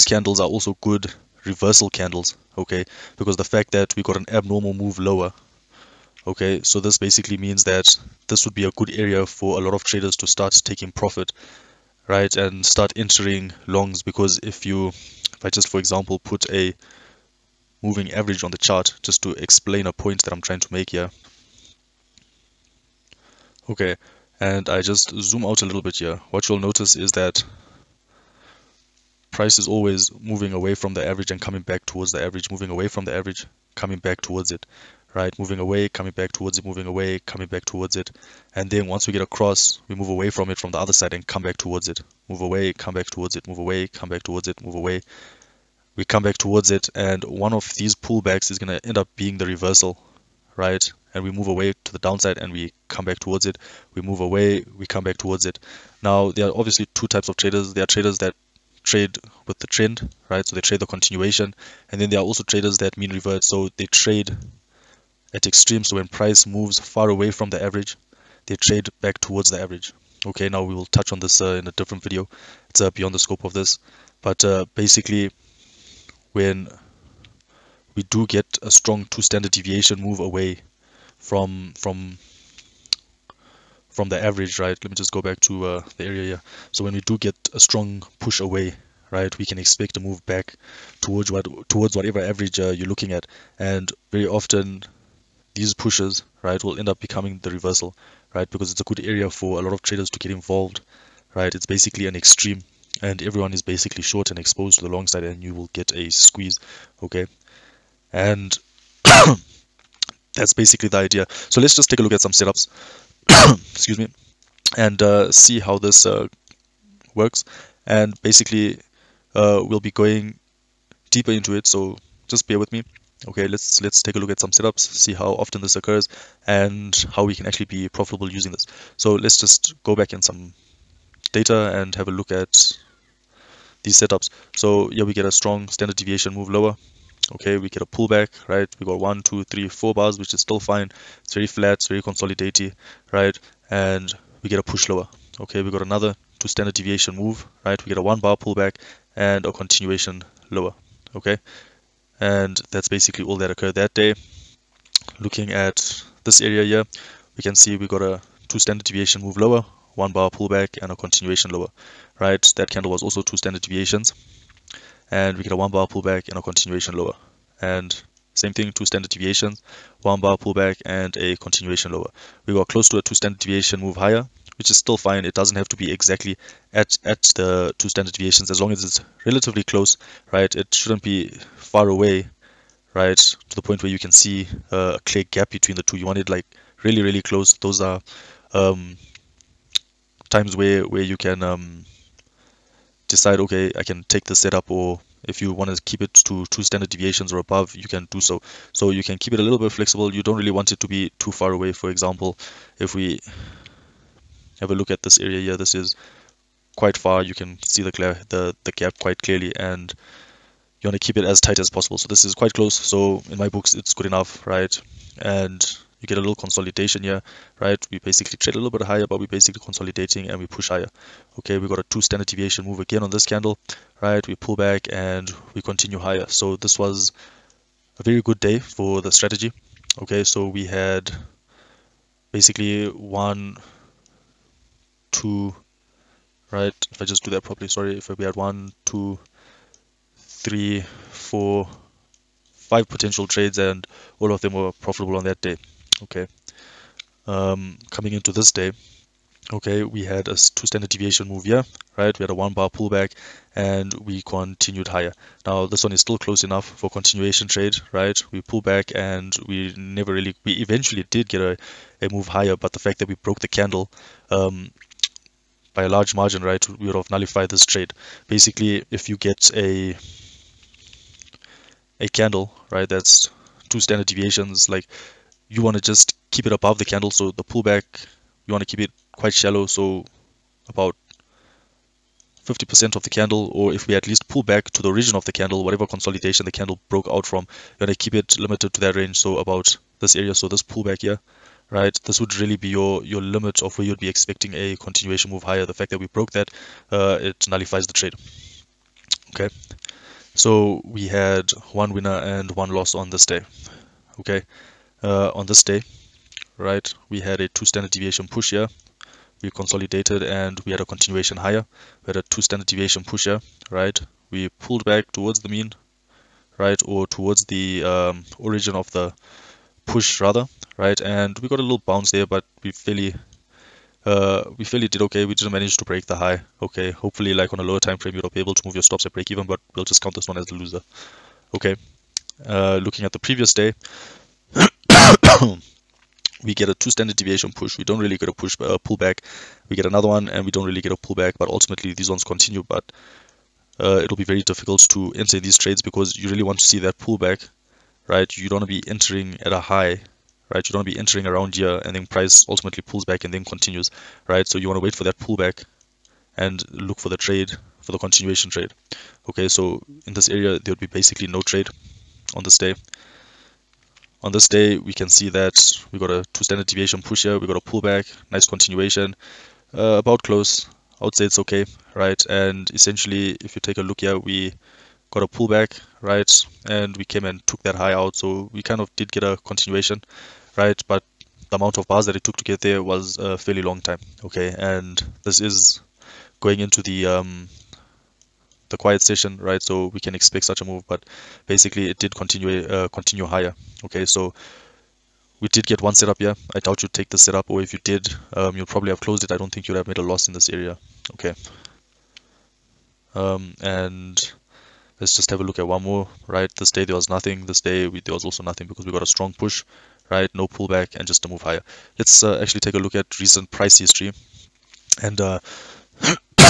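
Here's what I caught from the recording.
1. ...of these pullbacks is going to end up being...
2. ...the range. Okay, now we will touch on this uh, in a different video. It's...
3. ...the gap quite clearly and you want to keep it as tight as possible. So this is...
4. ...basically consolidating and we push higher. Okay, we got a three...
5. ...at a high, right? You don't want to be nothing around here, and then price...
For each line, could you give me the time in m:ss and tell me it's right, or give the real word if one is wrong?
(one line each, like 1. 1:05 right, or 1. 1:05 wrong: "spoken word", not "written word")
1. 0:47 right
2. 1:09 wrong: "average", not "range"
3. 3:28 right
4. 3:39 wrong: "two", not "three"
5. 5:49 wrong: "entering", not "nothing".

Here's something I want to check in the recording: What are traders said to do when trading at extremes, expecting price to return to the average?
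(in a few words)
mean revert.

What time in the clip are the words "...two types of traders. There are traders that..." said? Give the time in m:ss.
0:56.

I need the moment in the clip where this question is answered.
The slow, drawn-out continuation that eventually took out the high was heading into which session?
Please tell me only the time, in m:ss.
6:28.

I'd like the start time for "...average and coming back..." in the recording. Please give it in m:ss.
0:31.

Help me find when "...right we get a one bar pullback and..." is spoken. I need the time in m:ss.
2:27.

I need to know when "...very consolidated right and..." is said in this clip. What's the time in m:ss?
2:21.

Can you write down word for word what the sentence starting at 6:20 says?
But the amount of bars that it took to get there was a fairly long time, okay?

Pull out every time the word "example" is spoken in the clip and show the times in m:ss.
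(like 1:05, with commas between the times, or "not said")
0:15, 3:21.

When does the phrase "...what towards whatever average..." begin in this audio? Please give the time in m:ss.
1:31.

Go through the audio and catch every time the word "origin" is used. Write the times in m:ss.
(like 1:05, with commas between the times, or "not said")
4:44, 5:18.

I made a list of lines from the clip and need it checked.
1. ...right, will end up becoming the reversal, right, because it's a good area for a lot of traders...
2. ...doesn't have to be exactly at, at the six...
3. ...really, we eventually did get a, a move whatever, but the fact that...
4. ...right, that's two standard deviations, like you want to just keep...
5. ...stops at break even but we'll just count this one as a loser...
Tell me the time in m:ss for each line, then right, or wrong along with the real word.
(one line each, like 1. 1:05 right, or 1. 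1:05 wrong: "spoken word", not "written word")
1. 1:36 right
2. 2:55 wrong: "two", not "six"
3. 4:20 wrong: "higher", not "whatever"
4. 4:32 right
5. 5:28 right.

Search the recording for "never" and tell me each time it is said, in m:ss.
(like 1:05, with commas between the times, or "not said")
4:19.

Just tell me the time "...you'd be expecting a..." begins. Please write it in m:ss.
4:53.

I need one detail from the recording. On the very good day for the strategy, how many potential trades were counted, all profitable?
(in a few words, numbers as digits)
5.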